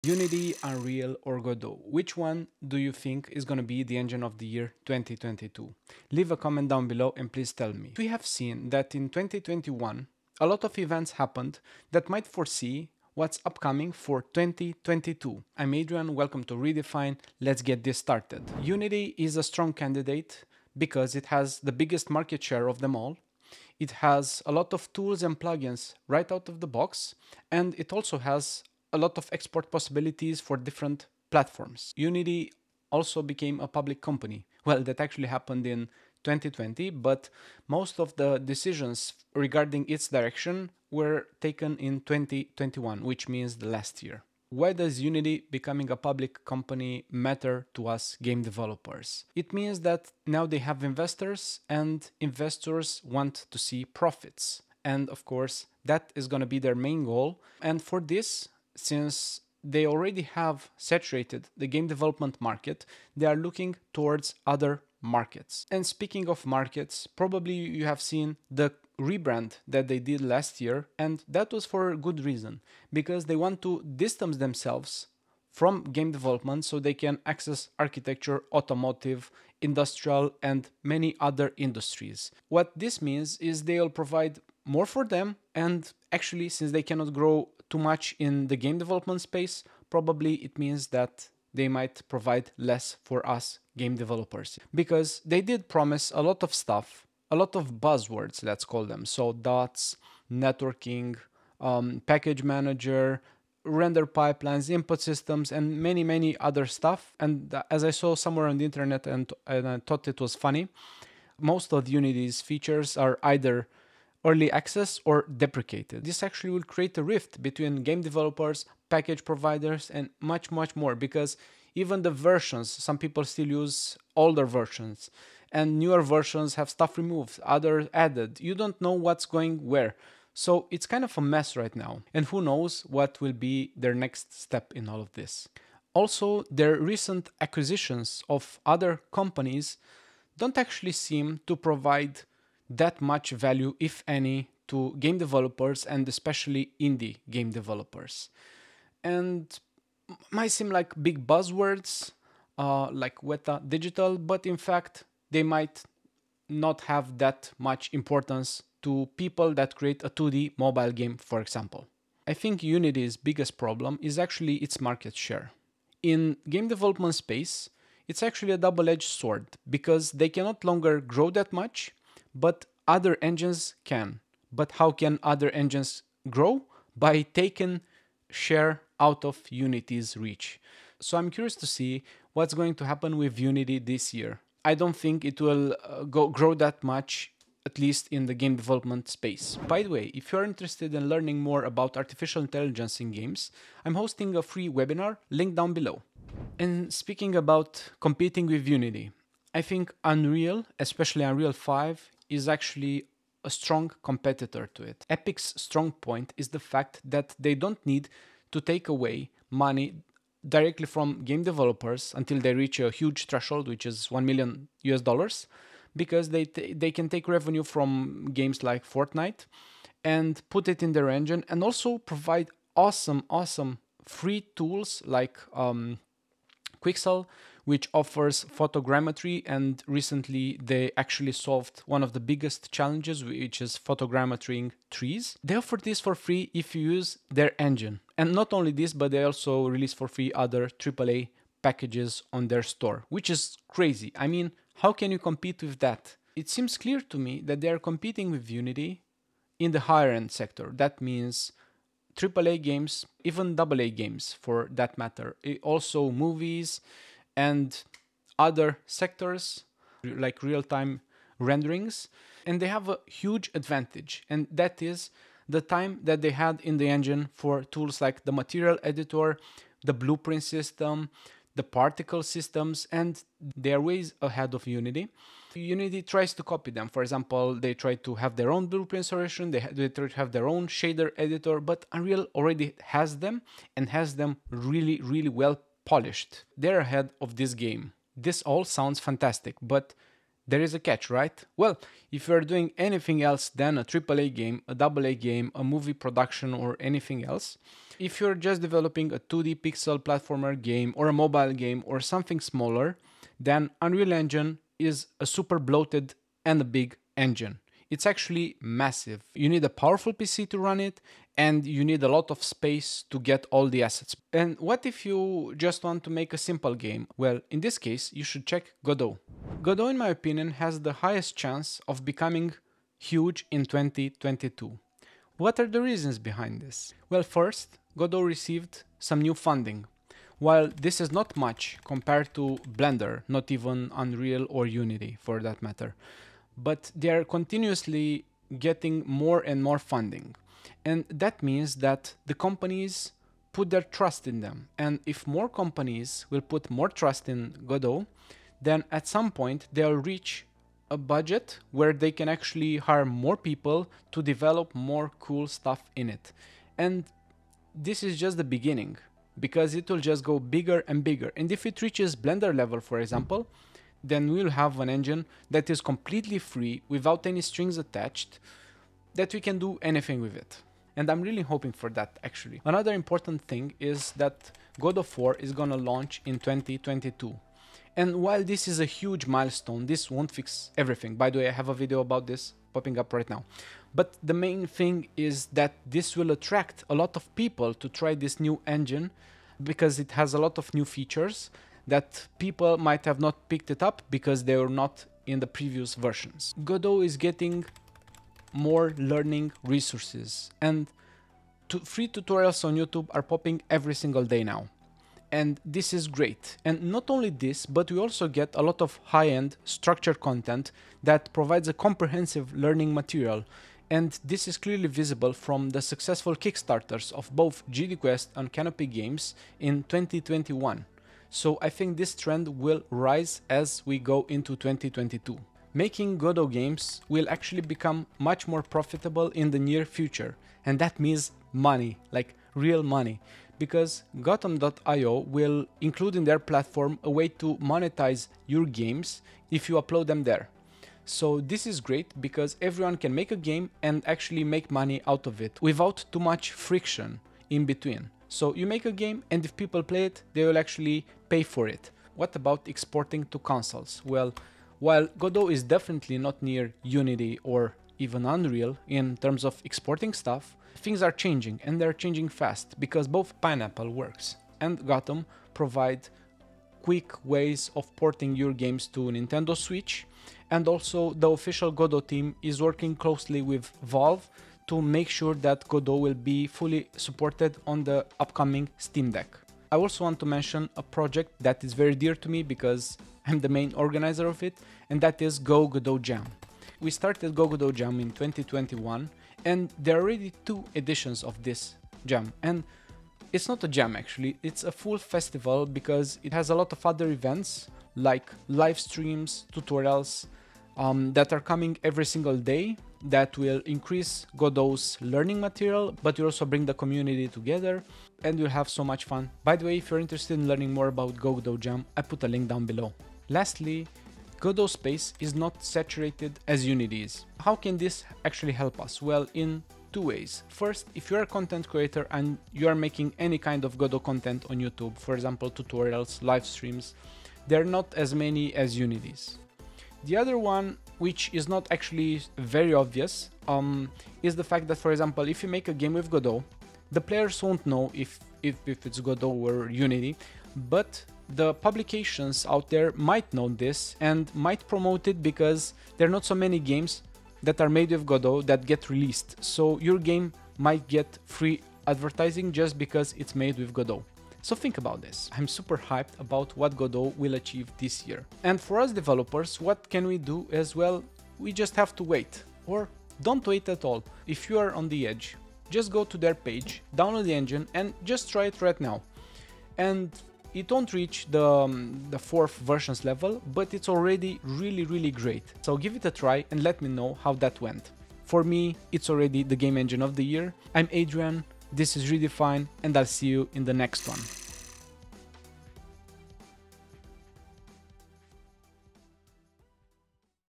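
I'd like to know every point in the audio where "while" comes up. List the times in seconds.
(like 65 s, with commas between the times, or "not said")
330 s, 378 s, 454 s.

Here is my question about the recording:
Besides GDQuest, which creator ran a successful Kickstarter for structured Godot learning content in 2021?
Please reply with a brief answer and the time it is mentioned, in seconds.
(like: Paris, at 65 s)
Canopy Games, at 418 s.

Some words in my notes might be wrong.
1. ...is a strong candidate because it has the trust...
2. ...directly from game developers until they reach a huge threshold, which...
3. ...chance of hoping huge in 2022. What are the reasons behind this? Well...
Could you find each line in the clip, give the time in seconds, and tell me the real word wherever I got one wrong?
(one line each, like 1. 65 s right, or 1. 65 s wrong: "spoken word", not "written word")
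1. 19 s wrong: "biggest", not "trust"
2. 210 s right
3. 321 s wrong: "becoming", not "hoping".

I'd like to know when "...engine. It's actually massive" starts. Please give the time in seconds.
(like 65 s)
307 s.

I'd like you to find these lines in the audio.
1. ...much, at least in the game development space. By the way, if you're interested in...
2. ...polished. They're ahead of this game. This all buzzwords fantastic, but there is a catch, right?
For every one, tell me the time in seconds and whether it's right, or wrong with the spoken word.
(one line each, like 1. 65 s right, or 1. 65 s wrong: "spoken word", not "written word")
1. 186 s right
2. 285 s wrong: "sounds", not "buzzwords".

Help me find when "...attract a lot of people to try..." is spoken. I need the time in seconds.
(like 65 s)
386 s.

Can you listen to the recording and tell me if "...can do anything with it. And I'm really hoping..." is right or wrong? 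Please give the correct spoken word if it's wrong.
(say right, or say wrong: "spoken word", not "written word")
right.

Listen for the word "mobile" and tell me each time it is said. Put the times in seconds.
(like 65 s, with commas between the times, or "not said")
160 s, 301 s.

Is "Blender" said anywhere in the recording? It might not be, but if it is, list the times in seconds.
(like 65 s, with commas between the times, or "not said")
332 s, 362 s.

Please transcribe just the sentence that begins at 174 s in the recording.
But how can other engines grow?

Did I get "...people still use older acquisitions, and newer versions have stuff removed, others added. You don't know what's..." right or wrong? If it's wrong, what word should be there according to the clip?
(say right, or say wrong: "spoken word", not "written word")
wrong: "versions", not "acquisitions".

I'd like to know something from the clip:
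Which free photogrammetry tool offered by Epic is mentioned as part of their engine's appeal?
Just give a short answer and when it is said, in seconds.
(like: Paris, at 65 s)
Quixel, at 226 s.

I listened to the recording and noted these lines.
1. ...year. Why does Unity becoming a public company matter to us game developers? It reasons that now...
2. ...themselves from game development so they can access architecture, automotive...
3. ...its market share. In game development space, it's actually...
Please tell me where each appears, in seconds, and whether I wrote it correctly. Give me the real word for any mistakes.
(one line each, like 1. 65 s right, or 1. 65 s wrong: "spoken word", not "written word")
1. 44 s wrong: "means", not "reasons"
2. 74 s right
3. 164 s right.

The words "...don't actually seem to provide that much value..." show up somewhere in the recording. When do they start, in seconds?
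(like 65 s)
140 s.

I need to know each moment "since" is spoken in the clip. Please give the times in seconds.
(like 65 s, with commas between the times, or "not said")
58 s, 86 s.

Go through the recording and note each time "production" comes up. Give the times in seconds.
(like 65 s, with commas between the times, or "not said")
296 s.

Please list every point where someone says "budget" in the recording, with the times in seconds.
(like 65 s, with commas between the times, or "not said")
350 s.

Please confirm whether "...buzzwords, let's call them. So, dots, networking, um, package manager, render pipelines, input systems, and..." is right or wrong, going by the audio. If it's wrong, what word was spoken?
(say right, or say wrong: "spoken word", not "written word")
right.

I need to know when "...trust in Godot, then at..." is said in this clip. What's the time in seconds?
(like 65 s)
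346 s.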